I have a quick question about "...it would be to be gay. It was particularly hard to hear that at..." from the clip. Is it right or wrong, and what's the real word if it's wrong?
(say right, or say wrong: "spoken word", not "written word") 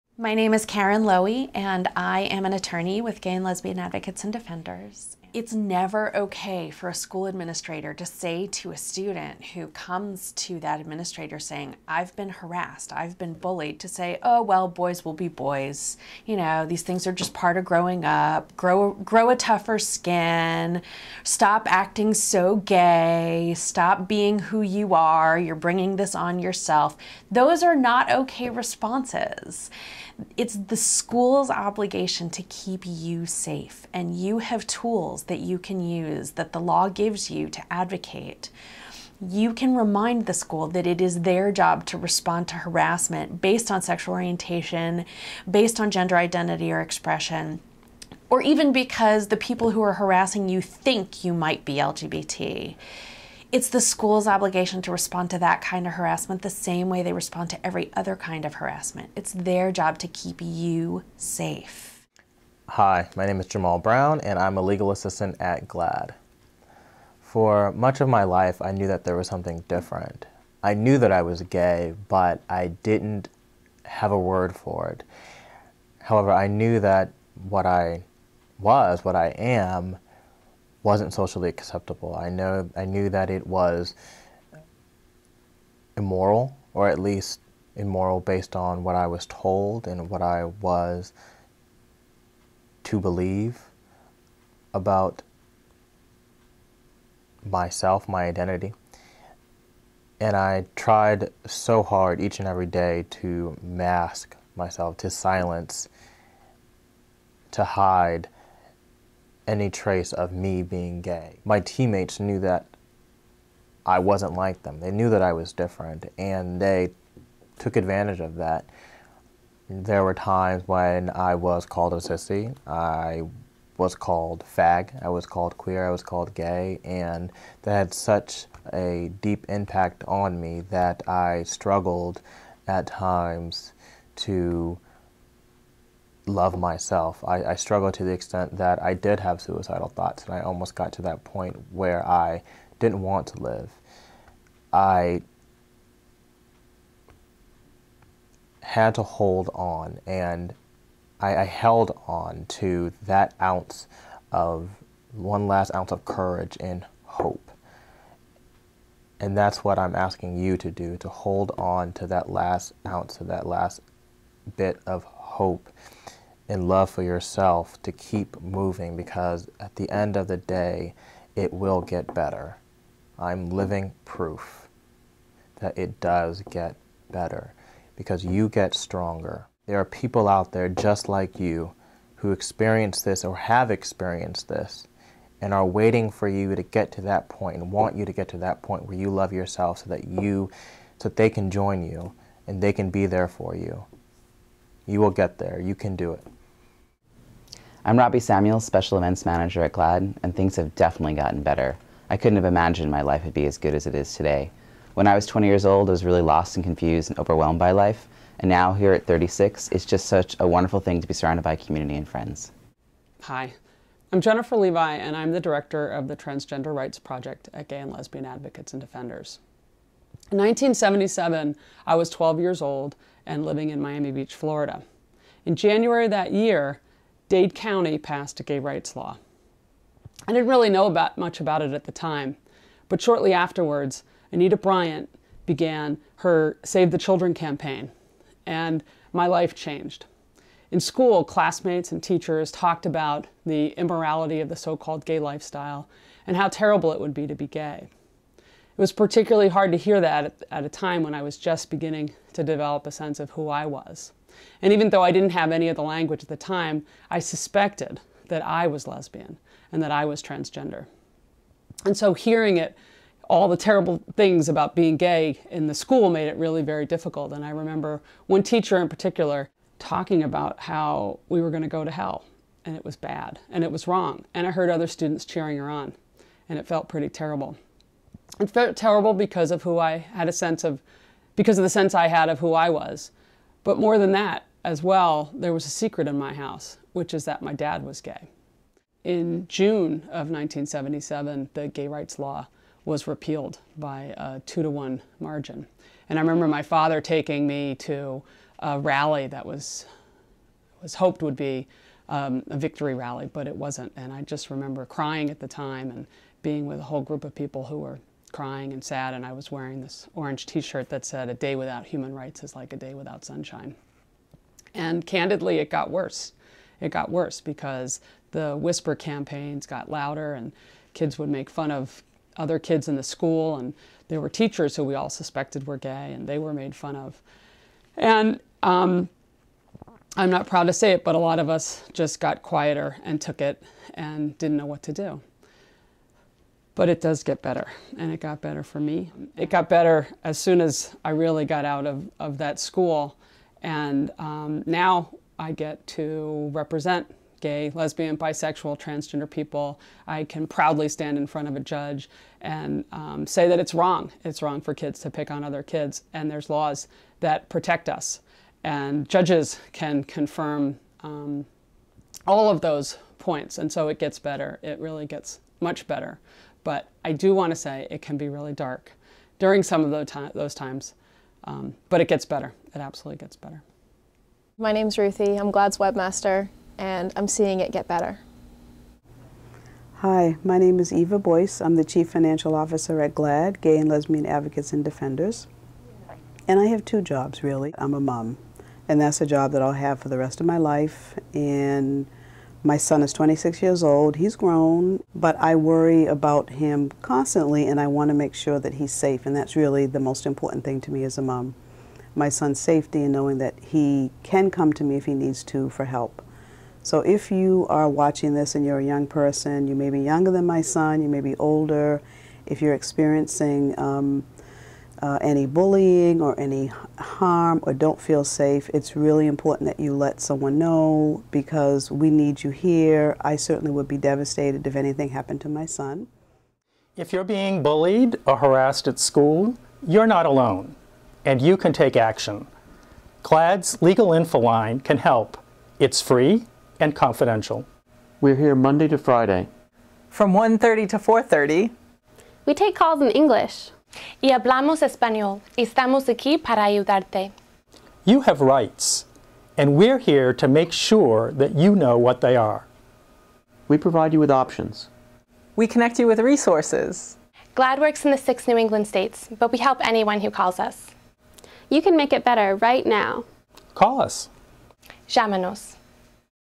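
right.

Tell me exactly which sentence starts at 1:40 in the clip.
And I tried so hard each and every day to mask myself, to silence, to hide any trace of me being gay.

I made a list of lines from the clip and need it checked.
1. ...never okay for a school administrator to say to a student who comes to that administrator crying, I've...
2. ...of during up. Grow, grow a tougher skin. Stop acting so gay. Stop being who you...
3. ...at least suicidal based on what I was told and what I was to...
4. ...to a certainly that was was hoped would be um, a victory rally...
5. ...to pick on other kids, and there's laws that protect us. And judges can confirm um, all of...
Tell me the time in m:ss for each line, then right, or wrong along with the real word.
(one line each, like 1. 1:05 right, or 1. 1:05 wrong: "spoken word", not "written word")
1. 0:05 wrong: "saying", not "crying"
2. 0:17 wrong: "growing", not "during"
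3. 1:26 wrong: "immoral", not "suicidal"
4. 4:57 wrong: "rally", not "certainly"
5. 5:55 right.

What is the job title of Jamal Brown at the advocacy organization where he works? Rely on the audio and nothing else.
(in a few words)
Legal assistant.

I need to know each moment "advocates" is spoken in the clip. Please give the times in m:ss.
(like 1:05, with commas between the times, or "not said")
0:03, 0:37, 3:38, 6:24.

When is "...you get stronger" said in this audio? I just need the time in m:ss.
2:58.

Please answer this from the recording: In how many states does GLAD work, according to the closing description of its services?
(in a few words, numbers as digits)
6.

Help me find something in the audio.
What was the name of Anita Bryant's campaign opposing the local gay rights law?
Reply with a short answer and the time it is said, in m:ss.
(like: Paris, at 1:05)
Save the Children, at 3:56.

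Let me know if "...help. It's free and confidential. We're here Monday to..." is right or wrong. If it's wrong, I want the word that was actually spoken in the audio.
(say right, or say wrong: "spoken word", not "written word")
right.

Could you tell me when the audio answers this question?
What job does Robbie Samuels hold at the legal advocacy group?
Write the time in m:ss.
3:18.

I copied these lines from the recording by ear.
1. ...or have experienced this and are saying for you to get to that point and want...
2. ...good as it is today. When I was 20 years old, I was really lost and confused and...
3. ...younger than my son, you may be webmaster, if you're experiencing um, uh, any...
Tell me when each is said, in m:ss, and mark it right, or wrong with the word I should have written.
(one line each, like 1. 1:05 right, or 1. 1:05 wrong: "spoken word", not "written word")
1. 3:03 wrong: "waiting", not "saying"
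2. 3:23 right
3. 6:50 wrong: "older", not "webmaster".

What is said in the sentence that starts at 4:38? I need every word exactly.
It felt terrible because of who I had a sense of, because of the sense I had of who I was.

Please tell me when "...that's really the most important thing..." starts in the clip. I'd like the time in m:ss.
6:39.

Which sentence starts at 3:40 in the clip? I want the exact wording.
In 1977, I was 12 years old and living in Miami Beach, Florida.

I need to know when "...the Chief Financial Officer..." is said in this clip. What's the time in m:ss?
6:21.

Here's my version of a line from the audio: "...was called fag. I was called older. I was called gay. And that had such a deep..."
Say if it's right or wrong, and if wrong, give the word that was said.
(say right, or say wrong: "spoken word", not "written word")
wrong: "queer", not "older".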